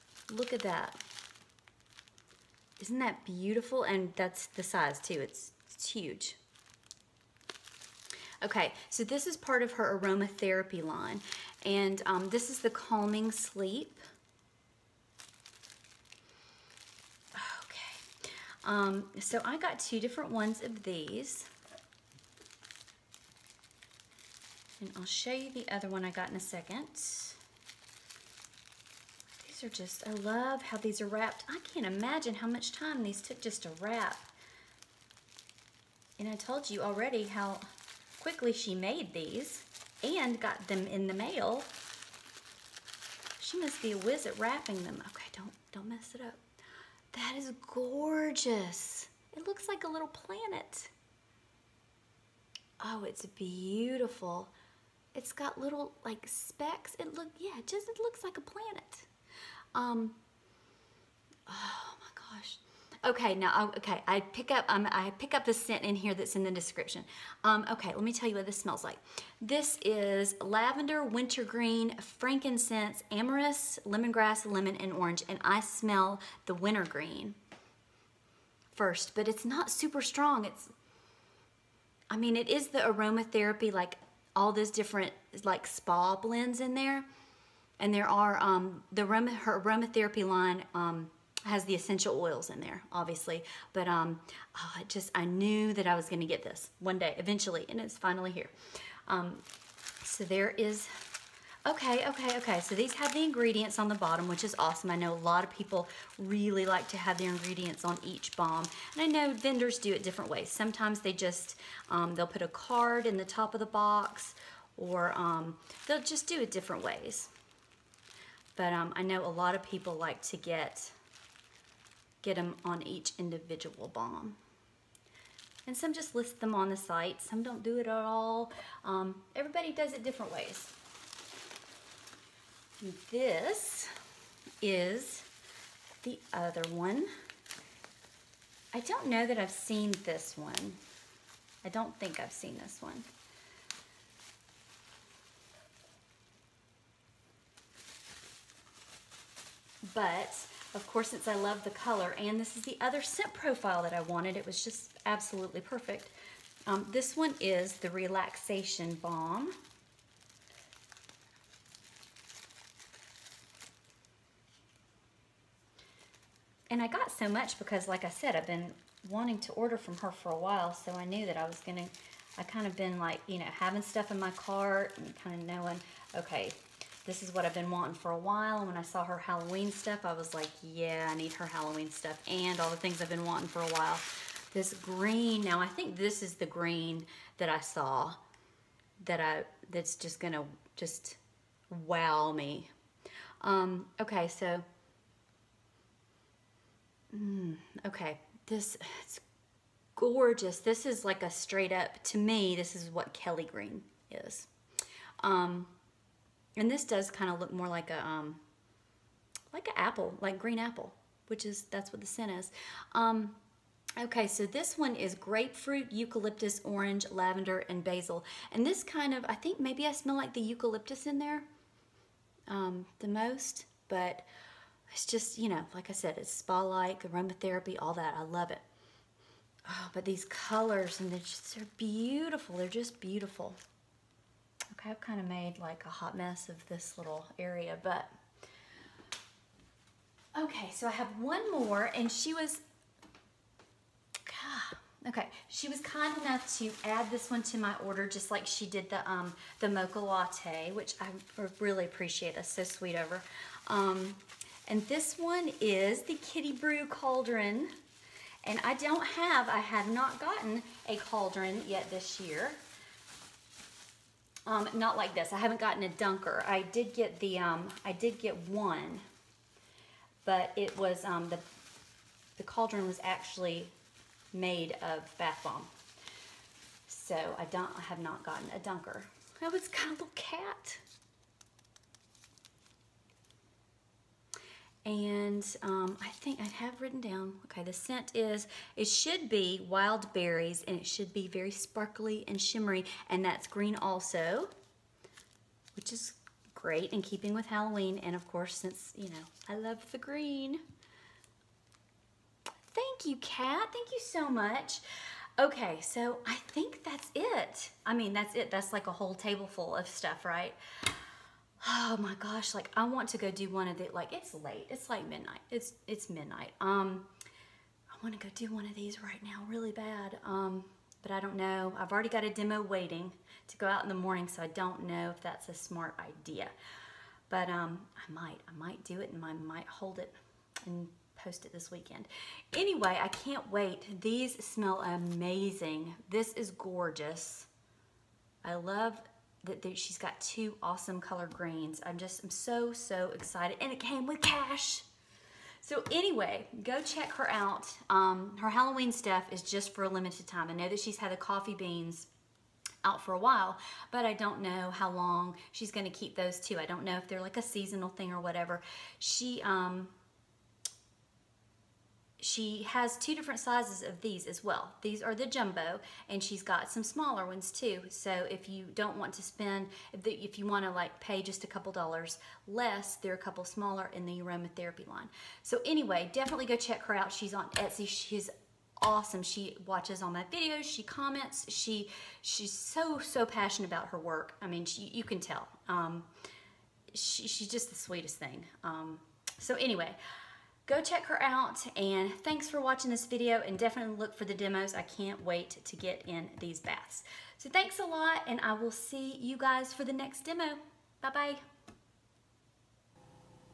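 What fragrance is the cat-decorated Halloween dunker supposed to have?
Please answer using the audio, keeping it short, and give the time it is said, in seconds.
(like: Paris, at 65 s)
Wild berries, at 289 s.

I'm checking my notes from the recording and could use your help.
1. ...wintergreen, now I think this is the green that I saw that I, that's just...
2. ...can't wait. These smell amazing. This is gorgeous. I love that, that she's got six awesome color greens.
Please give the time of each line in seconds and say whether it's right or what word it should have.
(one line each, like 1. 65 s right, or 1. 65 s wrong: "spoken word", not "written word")
1. 184 s wrong: "green", not "wintergreen"
2. 333 s wrong: "two", not "six".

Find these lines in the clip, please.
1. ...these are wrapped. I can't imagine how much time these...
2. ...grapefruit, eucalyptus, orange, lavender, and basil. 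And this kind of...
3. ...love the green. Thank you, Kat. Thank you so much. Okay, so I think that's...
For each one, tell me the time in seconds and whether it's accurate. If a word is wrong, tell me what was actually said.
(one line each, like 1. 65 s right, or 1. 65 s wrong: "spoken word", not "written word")
1. 30 s right
2. 215 s right
3. 299 s right.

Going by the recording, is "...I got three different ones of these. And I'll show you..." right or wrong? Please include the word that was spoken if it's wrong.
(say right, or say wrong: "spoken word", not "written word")
wrong: "two", not "three".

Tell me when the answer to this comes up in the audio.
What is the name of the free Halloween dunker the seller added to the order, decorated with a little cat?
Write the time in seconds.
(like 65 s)
256 s.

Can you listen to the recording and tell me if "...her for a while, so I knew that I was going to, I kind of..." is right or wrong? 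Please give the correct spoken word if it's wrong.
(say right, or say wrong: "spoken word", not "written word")
right.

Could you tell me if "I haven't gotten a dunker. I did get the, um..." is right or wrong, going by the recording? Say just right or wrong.
right.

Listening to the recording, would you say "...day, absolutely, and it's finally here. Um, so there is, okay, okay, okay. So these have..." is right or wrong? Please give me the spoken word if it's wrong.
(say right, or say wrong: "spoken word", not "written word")
wrong: "eventually", not "absolutely".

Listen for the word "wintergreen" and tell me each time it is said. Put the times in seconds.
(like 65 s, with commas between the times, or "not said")
71 s, 76 s.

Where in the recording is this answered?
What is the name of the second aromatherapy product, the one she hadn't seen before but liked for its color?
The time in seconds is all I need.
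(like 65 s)
157 s.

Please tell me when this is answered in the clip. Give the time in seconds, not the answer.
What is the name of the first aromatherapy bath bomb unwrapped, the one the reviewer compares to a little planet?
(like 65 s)
12 s.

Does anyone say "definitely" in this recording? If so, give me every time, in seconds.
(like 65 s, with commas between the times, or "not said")
376 s, 393 s.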